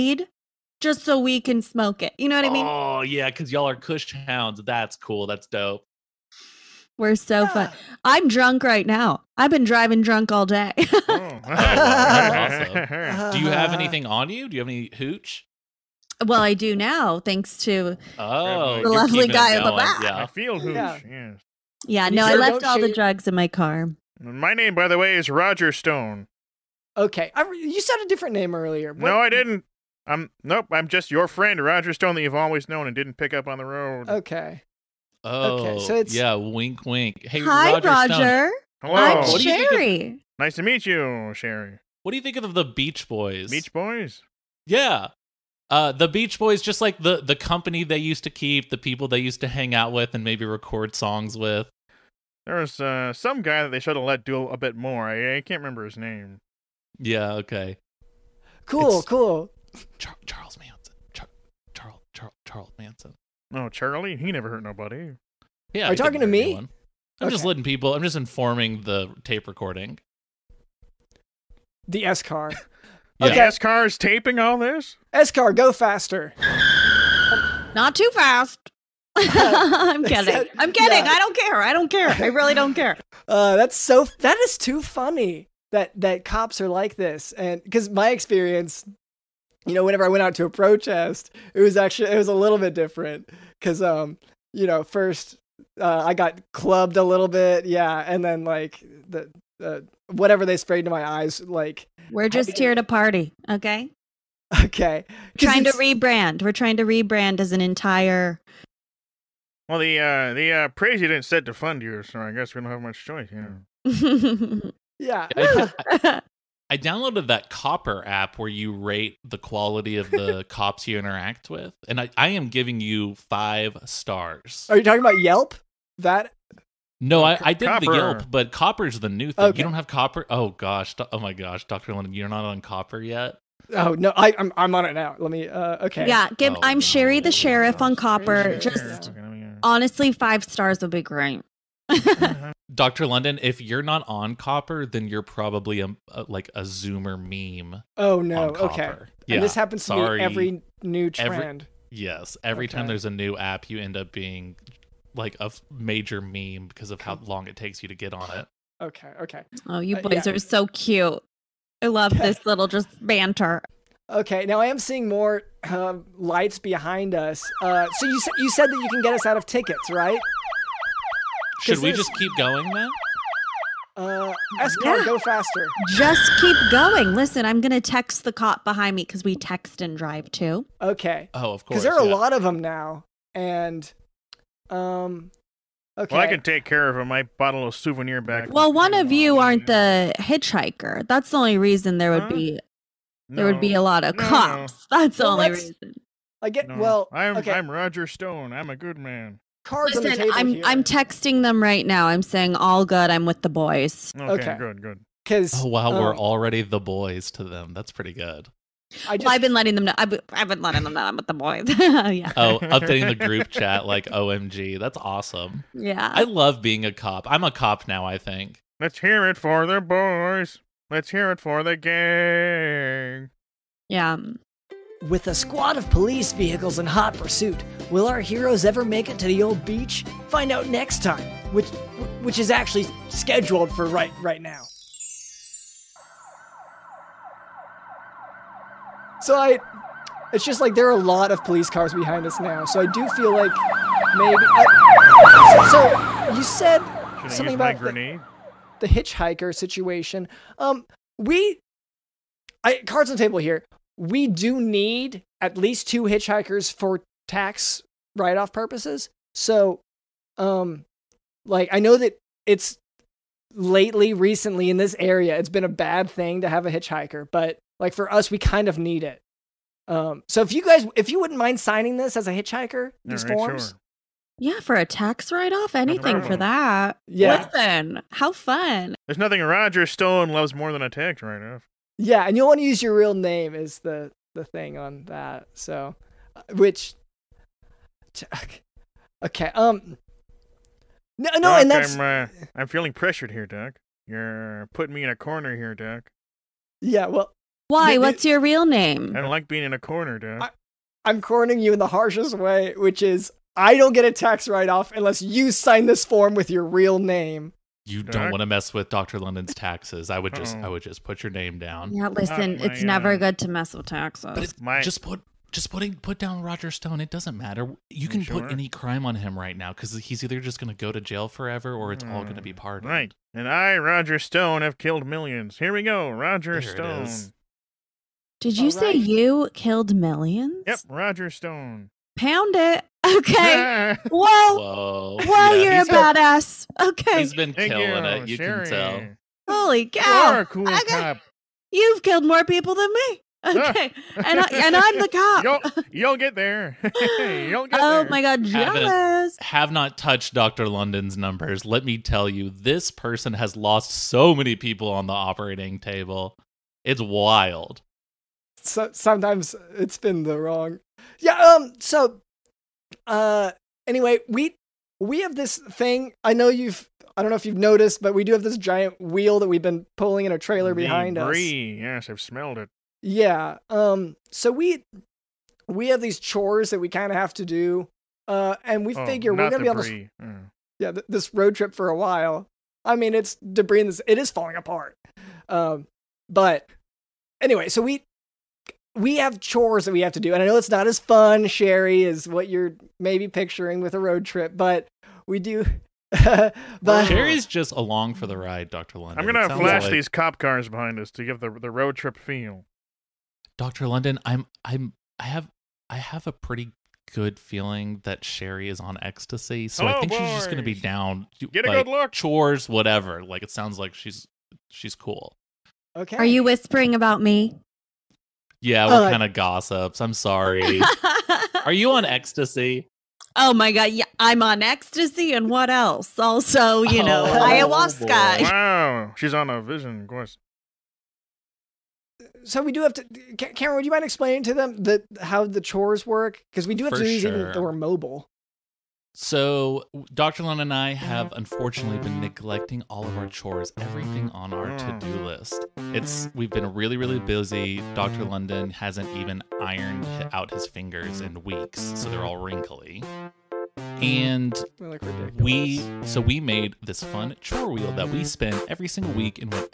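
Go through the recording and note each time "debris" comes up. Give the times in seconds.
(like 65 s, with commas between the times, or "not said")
371 s, 383 s.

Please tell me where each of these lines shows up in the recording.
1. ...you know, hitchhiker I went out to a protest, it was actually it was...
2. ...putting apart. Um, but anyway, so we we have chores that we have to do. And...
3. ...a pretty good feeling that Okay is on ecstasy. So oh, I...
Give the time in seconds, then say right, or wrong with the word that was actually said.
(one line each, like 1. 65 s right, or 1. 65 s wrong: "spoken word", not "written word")
1. 89 s wrong: "whenever", not "hitchhiker"
2. 384 s wrong: "falling", not "putting"
3. 406 s wrong: "Sherry", not "Okay".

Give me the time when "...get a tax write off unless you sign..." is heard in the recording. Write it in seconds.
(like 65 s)
303 s.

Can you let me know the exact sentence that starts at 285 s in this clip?
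So, uh, which okay, um, no, no, Doc, and that's I'm, uh, I'm feeling pressured here, Doc.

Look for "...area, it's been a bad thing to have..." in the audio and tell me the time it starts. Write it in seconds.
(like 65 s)
264 s.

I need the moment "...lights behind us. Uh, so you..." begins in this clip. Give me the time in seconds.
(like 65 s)
166 s.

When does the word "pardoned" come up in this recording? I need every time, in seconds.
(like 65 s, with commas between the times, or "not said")
322 s.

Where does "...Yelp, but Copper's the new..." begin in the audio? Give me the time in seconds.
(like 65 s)
127 s.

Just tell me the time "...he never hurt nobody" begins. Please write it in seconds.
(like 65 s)
64 s.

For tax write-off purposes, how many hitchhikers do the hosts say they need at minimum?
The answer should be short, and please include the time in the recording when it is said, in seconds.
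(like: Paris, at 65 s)
2, at 255 s.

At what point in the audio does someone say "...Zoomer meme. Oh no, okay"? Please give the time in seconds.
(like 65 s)
146 s.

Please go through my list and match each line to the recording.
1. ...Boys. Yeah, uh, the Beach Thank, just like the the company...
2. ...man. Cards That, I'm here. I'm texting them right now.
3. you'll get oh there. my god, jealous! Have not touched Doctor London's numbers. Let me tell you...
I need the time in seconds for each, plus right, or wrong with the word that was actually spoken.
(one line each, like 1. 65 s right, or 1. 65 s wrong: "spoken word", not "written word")
1. 43 s wrong: "Boys", not "Thank"
2. 198 s wrong: "Listen", not "That"
3. 346 s right.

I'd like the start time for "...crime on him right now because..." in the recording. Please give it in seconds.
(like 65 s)
318 s.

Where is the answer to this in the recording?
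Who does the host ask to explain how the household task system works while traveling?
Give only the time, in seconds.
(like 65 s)
433 s.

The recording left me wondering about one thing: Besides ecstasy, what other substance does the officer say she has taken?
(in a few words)
ayahuasca.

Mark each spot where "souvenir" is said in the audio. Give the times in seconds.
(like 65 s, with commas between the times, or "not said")
187 s.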